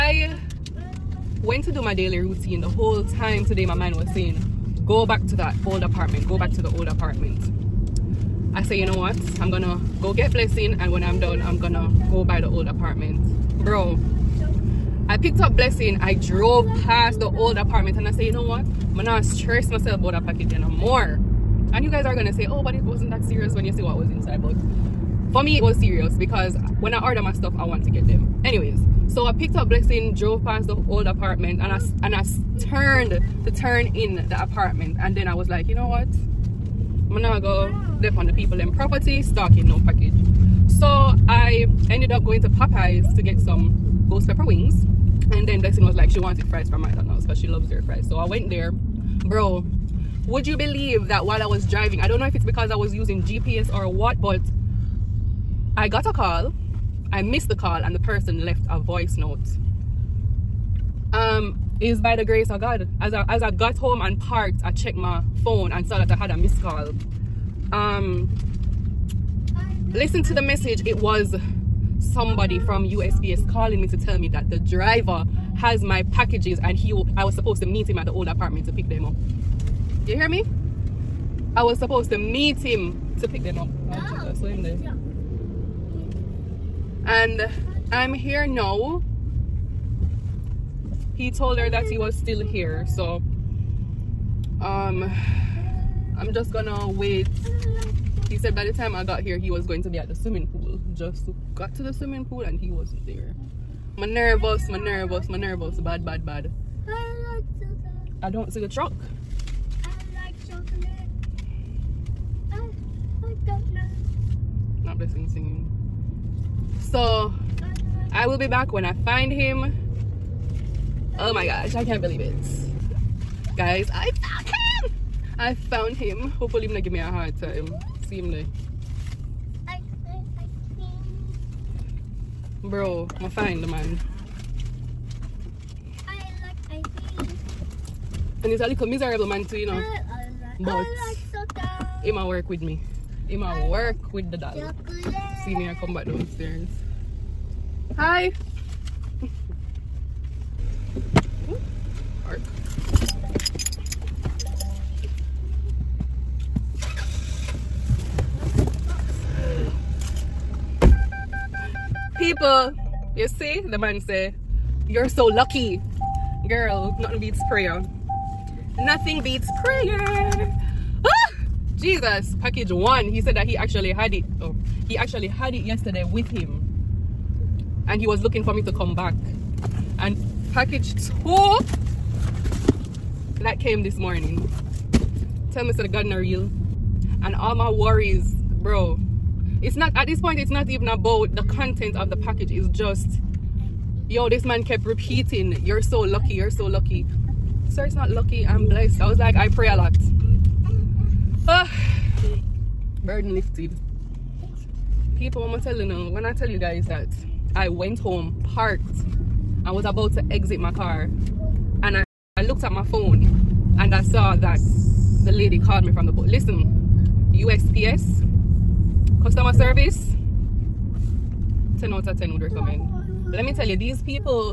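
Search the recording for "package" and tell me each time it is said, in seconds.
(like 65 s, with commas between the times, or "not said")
20 s, 39 s, 76 s, 172 s, 180 s, 192 s.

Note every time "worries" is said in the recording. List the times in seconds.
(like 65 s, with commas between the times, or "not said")
187 s.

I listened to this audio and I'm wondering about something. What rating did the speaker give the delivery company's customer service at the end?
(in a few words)
10 out of 10.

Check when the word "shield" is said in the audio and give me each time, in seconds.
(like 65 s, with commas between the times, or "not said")
not said.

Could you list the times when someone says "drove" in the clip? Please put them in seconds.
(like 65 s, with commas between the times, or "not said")
16 s, 30 s.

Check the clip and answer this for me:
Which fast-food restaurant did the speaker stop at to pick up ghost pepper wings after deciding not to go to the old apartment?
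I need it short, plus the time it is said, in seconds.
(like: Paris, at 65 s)
Popeyes, at 42 s.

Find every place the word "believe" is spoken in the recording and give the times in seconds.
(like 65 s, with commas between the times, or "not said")
50 s, 122 s.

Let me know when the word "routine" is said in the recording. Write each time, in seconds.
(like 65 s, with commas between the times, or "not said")
2 s.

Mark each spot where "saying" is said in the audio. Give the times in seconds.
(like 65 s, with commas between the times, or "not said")
4 s.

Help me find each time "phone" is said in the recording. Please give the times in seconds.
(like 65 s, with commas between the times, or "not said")
65 s, 212 s.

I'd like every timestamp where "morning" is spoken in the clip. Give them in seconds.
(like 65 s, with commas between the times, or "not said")
183 s.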